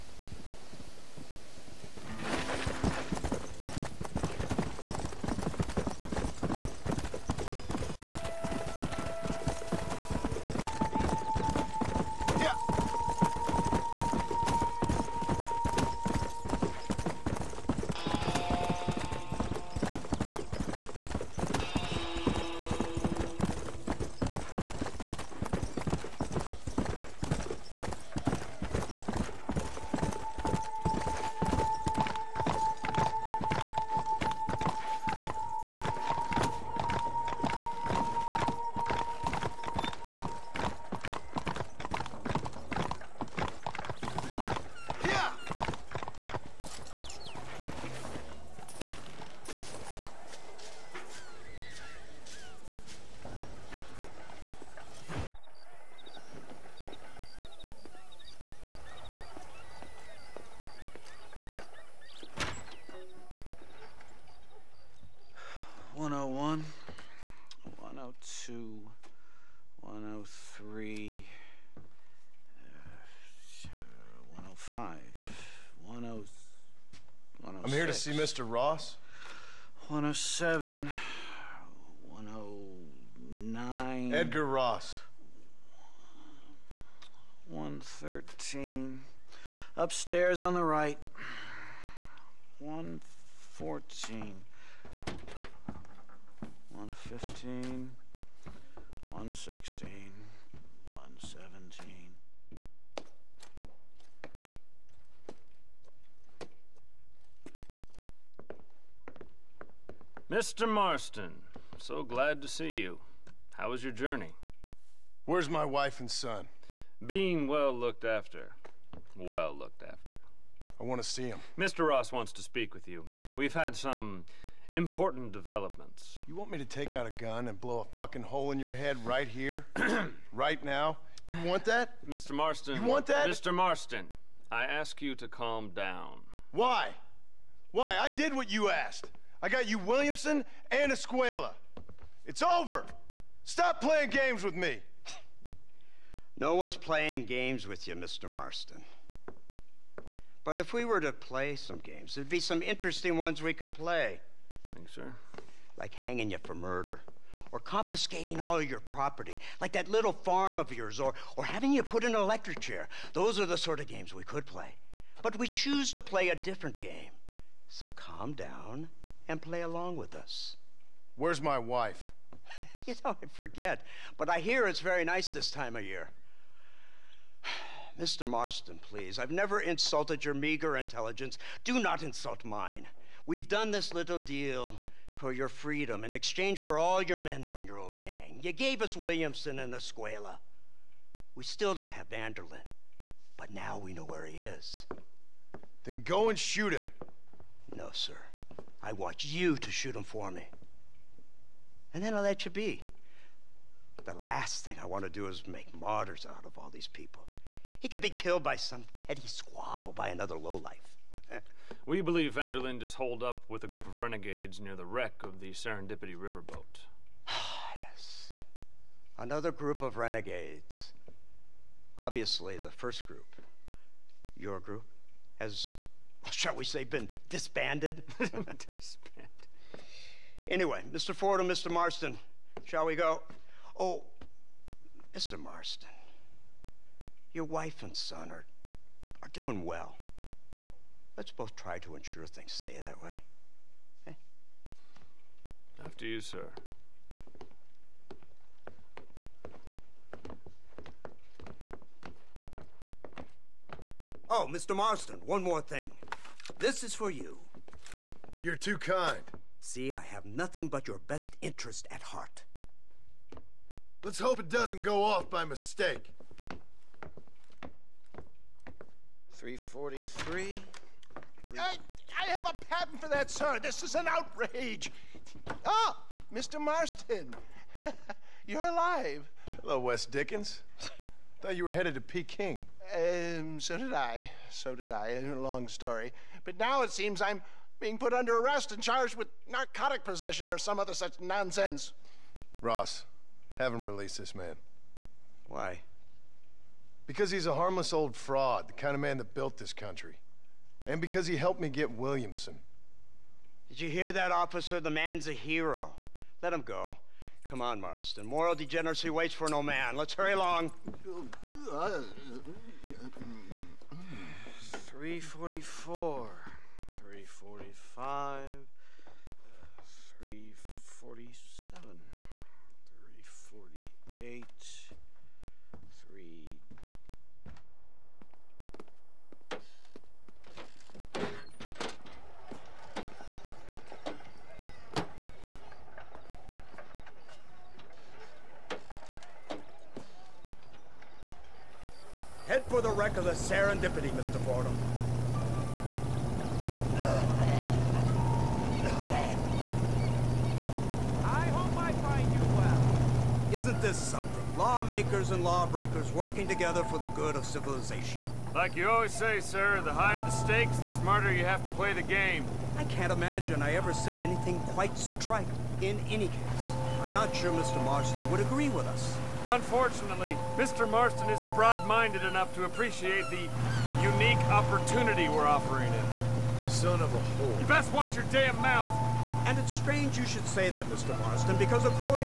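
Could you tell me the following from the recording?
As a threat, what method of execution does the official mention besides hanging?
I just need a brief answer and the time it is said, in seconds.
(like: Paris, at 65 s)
Electric chair, at 162 s.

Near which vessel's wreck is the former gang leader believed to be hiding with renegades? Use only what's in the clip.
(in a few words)
Serendipity riverboat.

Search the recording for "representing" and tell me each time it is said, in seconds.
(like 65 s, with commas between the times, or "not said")
not said.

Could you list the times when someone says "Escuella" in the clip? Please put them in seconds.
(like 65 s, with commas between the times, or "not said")
140 s, 189 s.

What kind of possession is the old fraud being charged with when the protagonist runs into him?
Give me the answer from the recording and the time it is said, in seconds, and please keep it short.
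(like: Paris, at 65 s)
Narcotic possession, at 289 s.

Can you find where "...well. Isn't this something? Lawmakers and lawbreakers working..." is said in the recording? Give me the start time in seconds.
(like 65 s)
352 s.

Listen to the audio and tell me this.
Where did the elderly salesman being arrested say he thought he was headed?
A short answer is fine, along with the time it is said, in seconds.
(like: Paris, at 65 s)
Peking, at 282 s.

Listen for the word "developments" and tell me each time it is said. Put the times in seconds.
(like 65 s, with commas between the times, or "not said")
125 s.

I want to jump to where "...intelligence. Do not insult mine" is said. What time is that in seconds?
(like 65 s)
180 s.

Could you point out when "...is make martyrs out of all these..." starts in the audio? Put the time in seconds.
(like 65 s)
205 s.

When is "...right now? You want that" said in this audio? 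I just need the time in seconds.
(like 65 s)
130 s.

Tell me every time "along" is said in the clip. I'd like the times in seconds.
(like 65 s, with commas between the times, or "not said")
169 s, 310 s.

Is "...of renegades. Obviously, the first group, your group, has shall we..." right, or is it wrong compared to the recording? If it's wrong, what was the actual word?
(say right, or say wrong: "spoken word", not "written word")
right.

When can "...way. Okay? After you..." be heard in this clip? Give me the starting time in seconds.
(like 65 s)
243 s.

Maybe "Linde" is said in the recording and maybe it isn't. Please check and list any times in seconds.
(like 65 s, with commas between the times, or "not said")
192 s, 212 s.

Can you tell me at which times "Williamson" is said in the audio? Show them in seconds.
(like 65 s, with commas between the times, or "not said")
139 s, 188 s, 301 s.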